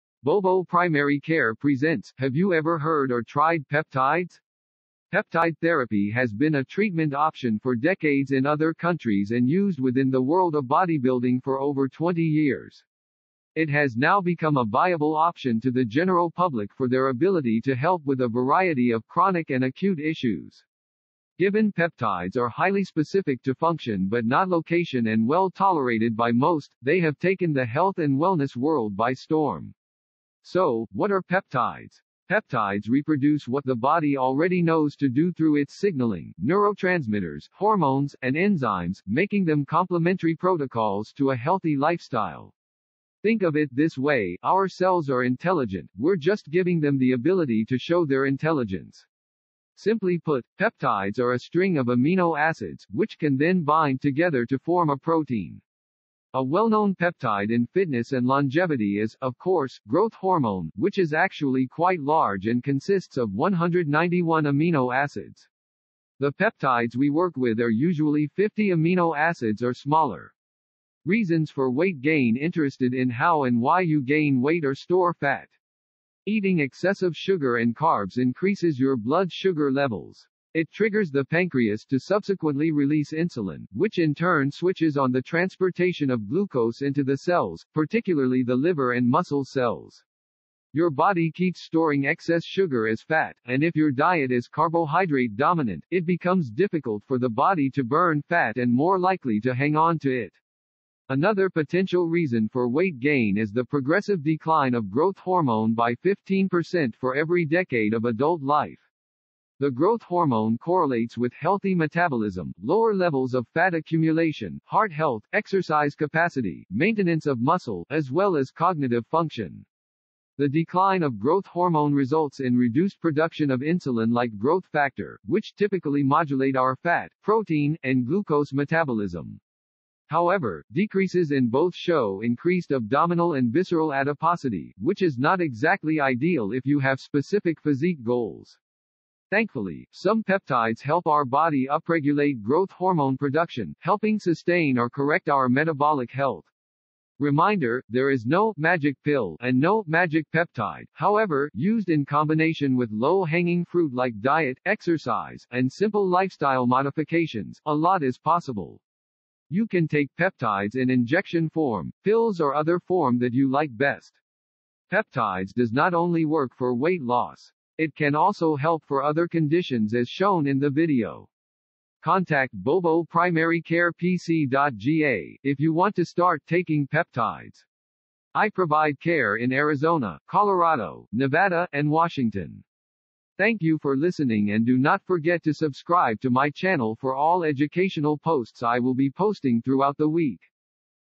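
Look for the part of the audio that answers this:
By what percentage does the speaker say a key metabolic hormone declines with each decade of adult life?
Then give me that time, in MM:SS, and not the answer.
01:45.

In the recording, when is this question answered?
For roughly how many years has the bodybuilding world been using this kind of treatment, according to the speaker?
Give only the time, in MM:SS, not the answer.
00:11.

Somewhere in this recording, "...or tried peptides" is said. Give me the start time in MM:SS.
00:03.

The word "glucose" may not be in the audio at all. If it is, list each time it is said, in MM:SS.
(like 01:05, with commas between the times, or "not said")
01:26, 02:08.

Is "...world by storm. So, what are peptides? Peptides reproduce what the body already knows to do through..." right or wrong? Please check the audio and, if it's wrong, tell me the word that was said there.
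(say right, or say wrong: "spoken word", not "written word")
right.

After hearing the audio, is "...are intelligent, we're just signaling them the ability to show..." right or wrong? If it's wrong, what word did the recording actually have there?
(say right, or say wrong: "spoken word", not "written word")
wrong: "giving", not "signaling".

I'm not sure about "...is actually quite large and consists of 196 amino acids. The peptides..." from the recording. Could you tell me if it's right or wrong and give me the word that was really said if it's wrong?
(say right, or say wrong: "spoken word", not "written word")
wrong: "191", not "196".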